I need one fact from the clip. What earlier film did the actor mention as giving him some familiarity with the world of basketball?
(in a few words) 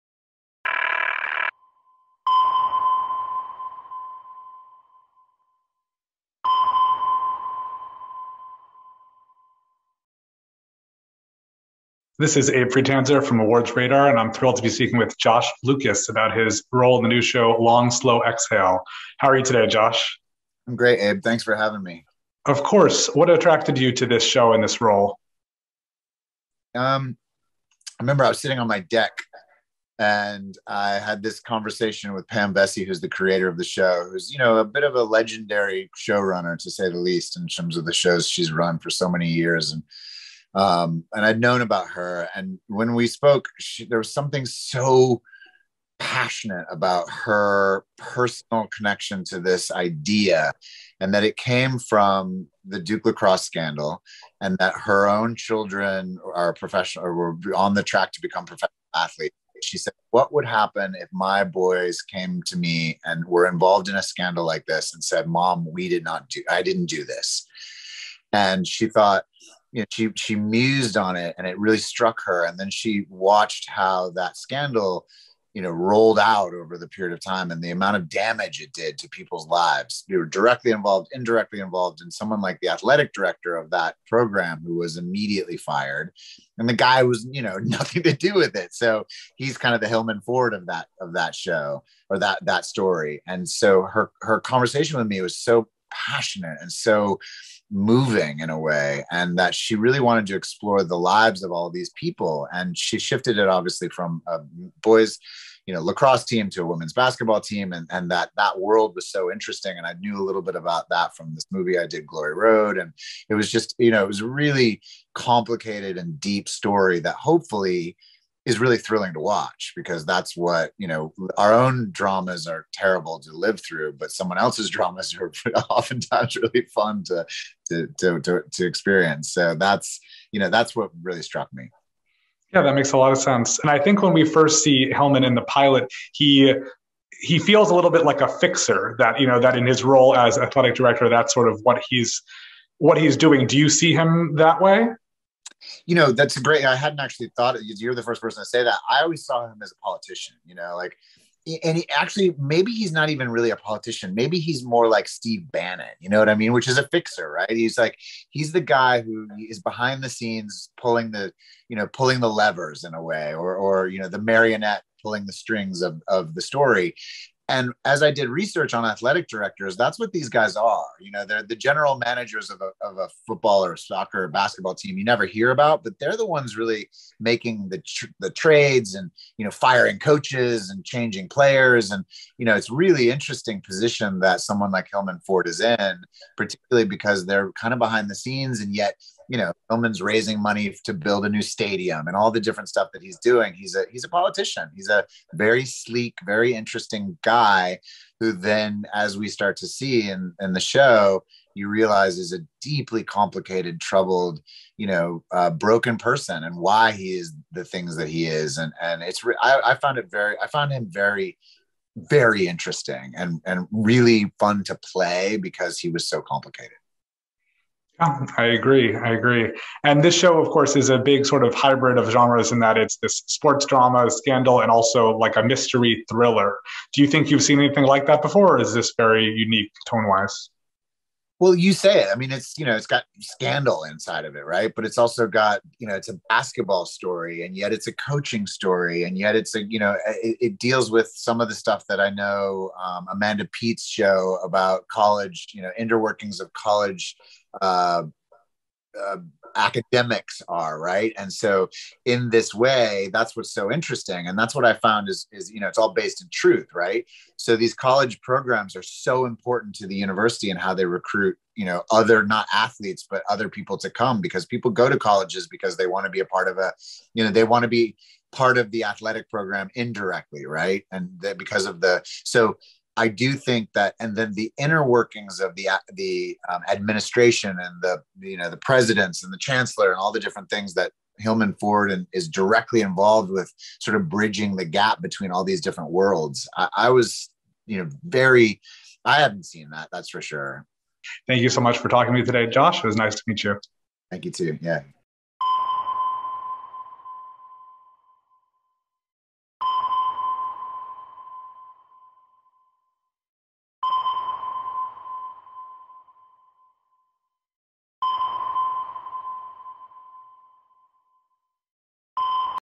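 Glory Road.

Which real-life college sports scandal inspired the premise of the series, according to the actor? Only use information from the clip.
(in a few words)
Duke lacrosse scandal.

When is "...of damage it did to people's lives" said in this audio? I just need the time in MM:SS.
01:17.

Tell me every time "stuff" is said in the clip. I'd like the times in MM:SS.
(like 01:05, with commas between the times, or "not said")
03:12, 04:01.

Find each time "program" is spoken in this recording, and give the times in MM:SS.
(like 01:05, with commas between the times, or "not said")
01:24, 04:18, 04:29.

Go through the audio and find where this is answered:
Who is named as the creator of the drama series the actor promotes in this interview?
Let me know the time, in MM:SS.
00:32.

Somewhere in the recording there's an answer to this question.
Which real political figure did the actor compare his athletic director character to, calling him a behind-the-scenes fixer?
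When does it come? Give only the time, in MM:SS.
02:35.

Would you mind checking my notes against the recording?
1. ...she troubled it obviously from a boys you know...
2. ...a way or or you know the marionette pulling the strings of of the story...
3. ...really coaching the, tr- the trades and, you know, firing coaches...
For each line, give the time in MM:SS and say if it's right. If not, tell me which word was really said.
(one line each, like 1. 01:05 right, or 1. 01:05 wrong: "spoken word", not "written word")
1. 01:42 wrong: "shifted", not "troubled"
2. 02:42 right
3. 02:56 wrong: "making", not "coaching".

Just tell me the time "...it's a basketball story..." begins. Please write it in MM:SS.
03:55.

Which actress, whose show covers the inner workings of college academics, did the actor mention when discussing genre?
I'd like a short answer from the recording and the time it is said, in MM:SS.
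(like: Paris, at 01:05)
Amanda Peet, at 04:03.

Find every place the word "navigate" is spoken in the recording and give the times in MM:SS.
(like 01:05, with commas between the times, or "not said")
not said.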